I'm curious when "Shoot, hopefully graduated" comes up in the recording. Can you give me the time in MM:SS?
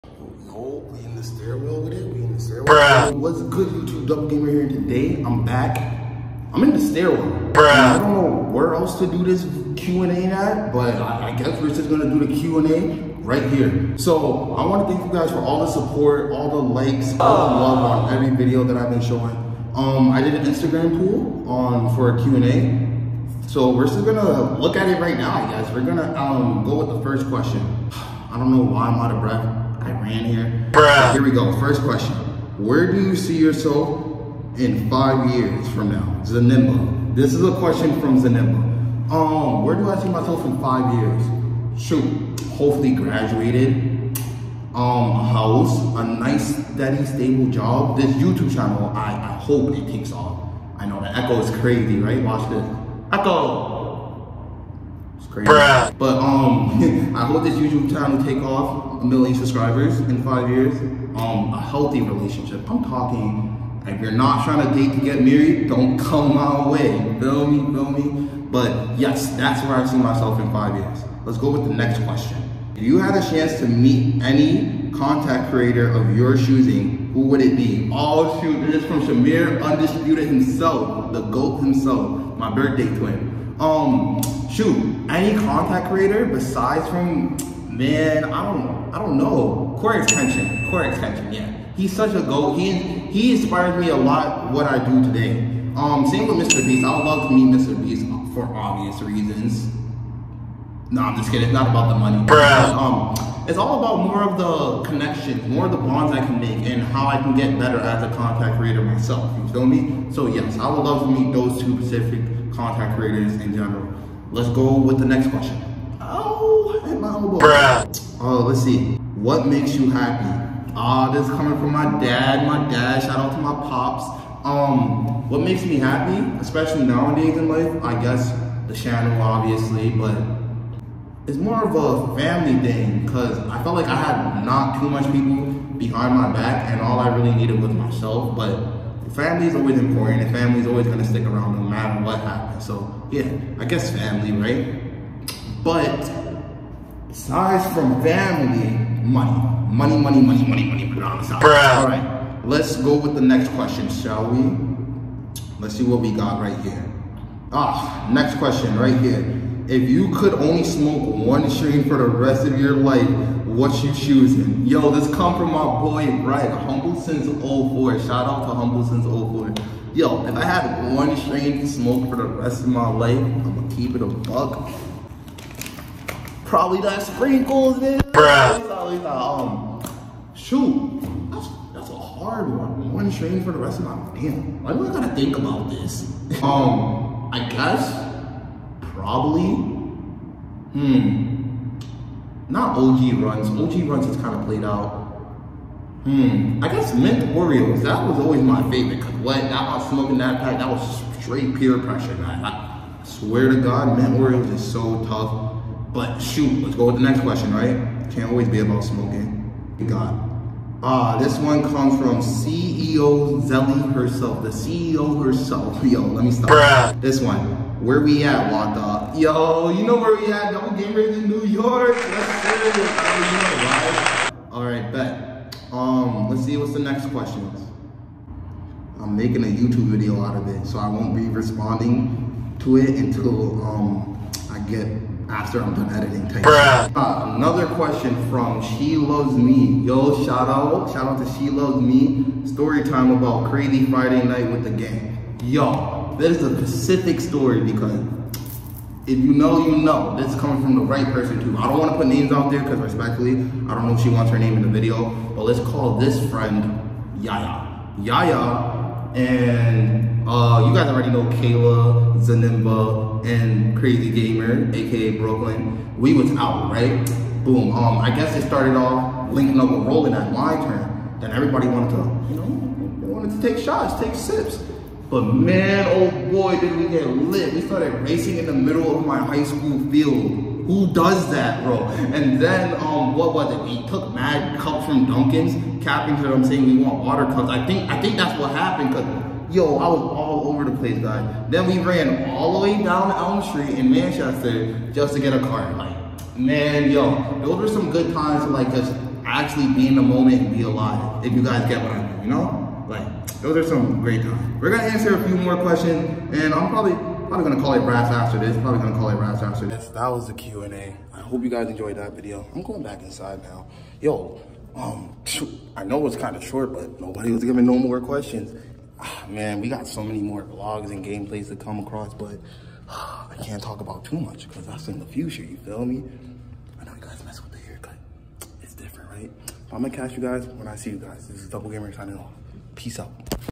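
00:41.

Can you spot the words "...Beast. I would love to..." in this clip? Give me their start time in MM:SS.
01:36.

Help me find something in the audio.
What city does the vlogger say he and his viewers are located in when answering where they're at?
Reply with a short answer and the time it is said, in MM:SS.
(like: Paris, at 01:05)
New York, at 03:41.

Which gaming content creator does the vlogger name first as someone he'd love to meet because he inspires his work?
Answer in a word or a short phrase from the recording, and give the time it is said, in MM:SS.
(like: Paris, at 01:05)
CoryxKenshin, at 01:29.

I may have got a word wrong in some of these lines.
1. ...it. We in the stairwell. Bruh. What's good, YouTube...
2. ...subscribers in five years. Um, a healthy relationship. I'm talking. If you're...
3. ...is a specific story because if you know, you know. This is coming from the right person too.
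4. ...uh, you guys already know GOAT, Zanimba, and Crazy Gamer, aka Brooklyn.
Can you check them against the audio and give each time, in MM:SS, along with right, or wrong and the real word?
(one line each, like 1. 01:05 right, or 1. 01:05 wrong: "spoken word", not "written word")
1. 00:01 right
2. 00:59 right
3. 04:06 right
4. 04:20 wrong: "Kayla", not "GOAT".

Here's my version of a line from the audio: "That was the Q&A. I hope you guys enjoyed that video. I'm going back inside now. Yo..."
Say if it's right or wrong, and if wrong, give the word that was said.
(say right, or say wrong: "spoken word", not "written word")
right.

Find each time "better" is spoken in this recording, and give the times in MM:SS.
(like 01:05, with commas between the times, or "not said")
01:47.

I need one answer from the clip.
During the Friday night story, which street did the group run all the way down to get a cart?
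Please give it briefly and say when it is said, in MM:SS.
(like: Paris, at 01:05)
Elm Street, at 04:53.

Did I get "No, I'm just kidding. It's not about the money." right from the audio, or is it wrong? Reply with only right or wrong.
right.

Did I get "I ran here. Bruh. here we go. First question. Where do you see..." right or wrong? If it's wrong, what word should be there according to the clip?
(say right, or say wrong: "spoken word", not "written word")
right.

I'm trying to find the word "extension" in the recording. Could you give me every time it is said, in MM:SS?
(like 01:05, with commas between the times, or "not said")
01:30.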